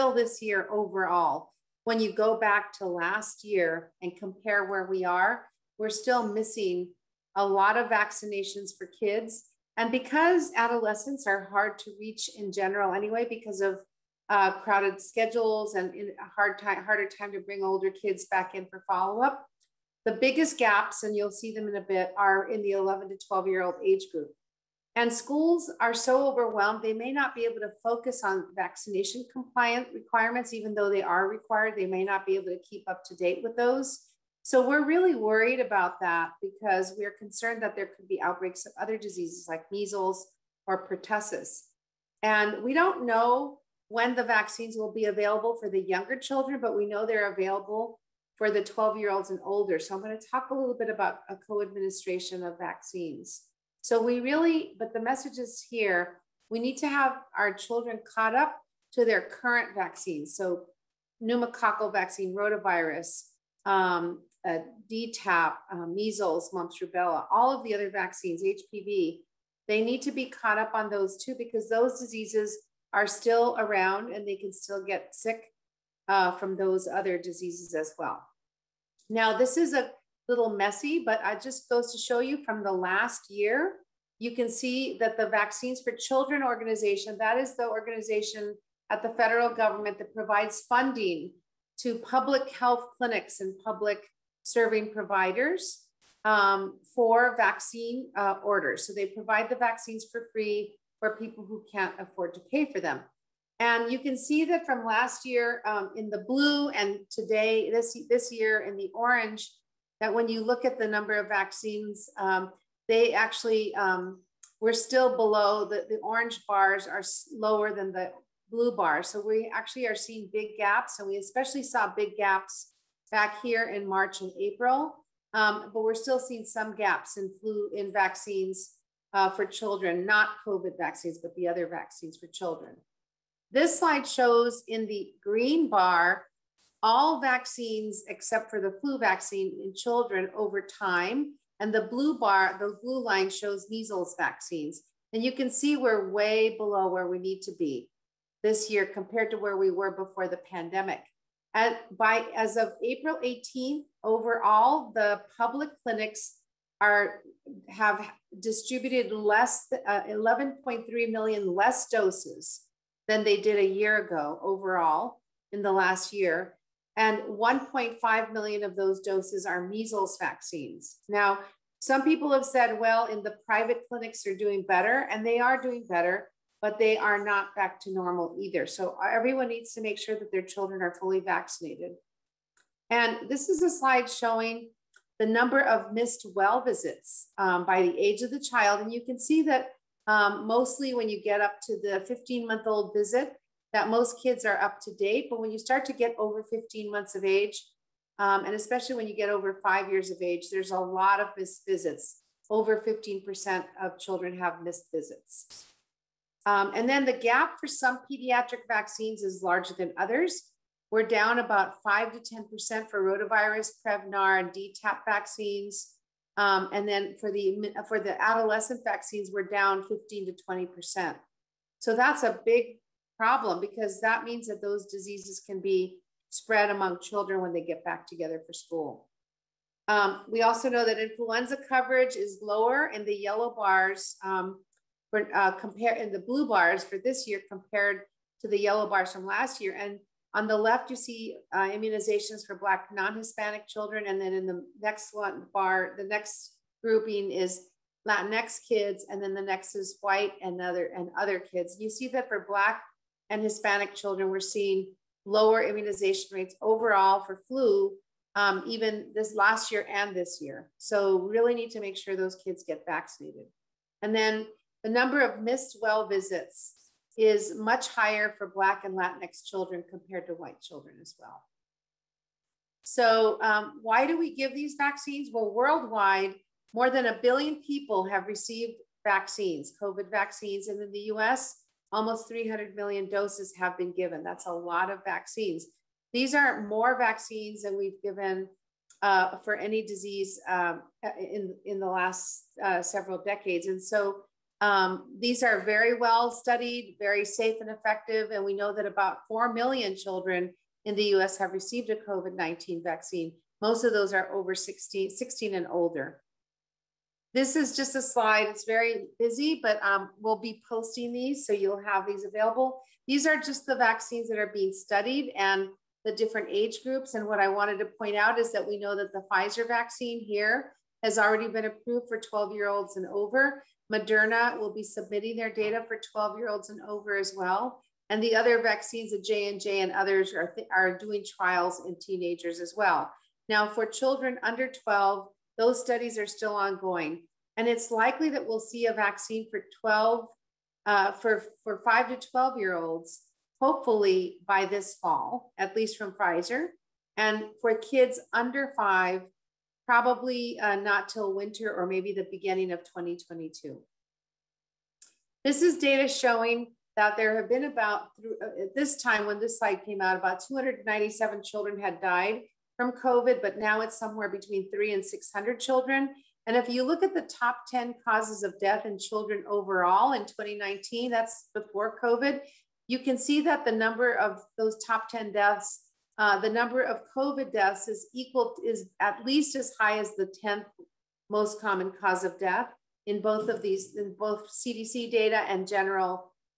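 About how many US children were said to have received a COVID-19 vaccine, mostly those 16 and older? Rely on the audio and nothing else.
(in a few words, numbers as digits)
4 million.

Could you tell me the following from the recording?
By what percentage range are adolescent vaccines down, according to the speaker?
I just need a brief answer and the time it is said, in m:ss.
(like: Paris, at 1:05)
15 to 20%, at 3:39.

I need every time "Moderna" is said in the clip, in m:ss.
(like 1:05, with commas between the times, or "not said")
5:23.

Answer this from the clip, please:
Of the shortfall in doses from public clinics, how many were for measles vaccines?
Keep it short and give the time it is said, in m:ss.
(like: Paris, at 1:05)
1.5 million, at 2:47.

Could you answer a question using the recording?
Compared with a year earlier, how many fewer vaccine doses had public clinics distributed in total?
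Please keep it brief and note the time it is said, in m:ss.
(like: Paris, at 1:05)
11.3 million, at 2:40.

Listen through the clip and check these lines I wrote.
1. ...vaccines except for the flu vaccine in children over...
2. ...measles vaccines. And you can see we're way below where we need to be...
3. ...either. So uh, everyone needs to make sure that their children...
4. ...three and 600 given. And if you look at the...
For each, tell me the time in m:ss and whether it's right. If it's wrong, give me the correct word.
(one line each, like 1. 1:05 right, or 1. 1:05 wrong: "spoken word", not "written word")
1. 2:17 right
2. 2:23 right
3. 2:58 right
4. 6:04 wrong: "children", not "given".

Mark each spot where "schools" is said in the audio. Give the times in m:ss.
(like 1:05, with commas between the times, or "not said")
0:25, 3:48.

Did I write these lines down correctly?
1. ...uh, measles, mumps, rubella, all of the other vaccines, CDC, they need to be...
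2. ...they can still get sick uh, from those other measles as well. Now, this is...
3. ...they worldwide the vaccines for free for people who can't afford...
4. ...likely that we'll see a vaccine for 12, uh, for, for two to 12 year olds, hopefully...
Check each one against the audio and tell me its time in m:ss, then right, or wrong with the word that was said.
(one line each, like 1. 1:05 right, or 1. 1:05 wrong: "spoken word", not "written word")
1. 1:05 wrong: "HPV", not "CDC"
2. 1:14 wrong: "diseases", not "measles"
3. 1:38 wrong: "provide", not "worldwide"
4. 5:37 wrong: "five", not "two".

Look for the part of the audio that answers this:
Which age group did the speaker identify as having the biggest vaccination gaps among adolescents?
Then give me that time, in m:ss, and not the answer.
0:22.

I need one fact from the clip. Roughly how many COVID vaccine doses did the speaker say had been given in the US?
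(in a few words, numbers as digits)
300 million.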